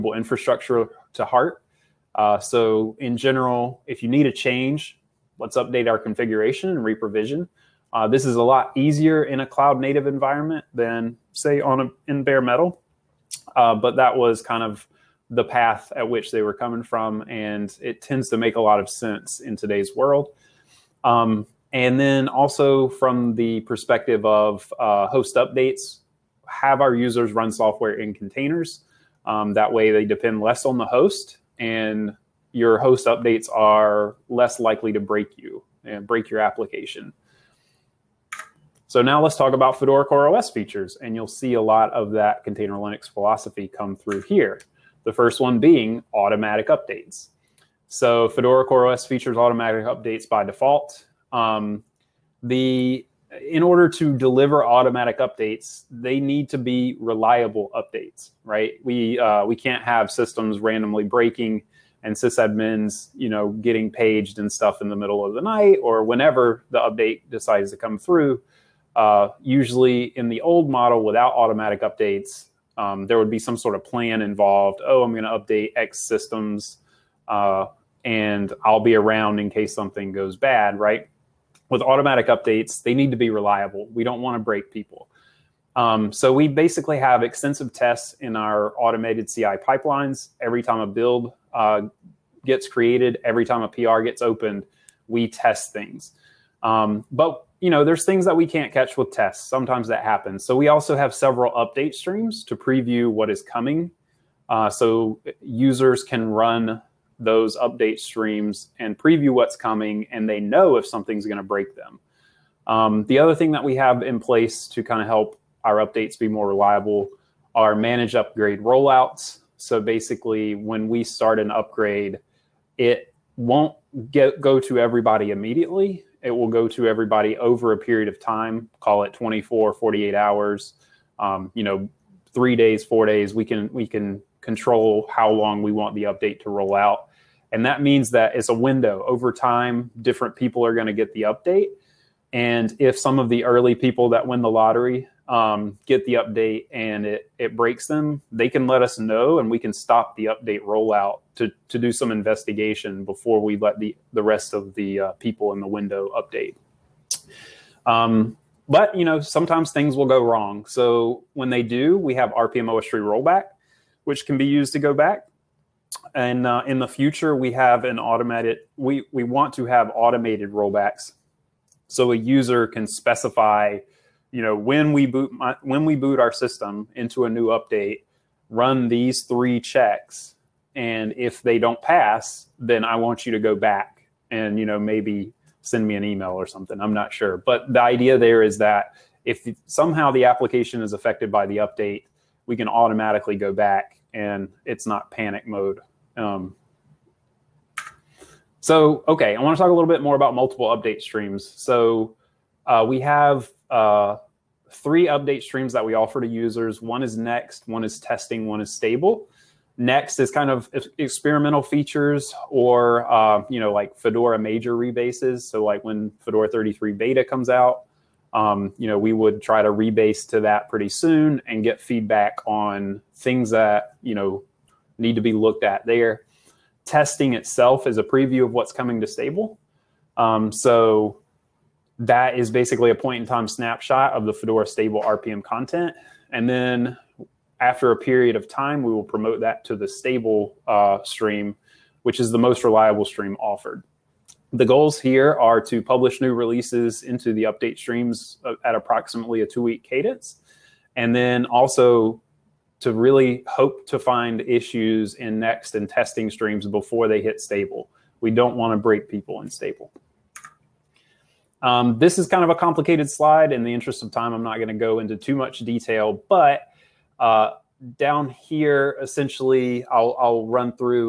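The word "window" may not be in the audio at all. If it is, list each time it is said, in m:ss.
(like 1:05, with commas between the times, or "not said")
2:18, 2:35.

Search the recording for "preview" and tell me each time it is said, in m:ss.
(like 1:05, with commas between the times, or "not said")
1:42, 1:48, 3:48.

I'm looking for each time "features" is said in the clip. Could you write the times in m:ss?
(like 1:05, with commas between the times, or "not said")
0:40, 0:49, 3:31.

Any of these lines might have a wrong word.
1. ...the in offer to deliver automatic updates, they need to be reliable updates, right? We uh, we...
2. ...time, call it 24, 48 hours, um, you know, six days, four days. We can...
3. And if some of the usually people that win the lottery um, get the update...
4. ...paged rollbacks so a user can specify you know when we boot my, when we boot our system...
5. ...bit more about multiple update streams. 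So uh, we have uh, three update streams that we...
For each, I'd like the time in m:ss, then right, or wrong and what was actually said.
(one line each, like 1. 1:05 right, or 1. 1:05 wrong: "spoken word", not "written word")
1. 0:52 wrong: "order", not "offer"
2. 2:08 wrong: "three", not "six"
3. 2:22 wrong: "early", not "usually"
4. 2:49 wrong: "automated", not "paged"
5. 3:19 right.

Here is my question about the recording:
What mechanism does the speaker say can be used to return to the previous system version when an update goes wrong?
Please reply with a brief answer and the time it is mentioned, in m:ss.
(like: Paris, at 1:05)
OSTree rollback, at 2:42.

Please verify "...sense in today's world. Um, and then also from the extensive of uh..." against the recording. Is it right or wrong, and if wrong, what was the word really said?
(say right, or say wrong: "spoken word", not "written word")
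wrong: "perspective", not "extensive".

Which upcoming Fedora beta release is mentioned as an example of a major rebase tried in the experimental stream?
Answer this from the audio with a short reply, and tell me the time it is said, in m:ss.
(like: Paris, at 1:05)
Fedora 33 beta, at 3:36.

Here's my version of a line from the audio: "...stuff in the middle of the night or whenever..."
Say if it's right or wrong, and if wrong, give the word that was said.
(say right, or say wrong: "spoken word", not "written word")
right.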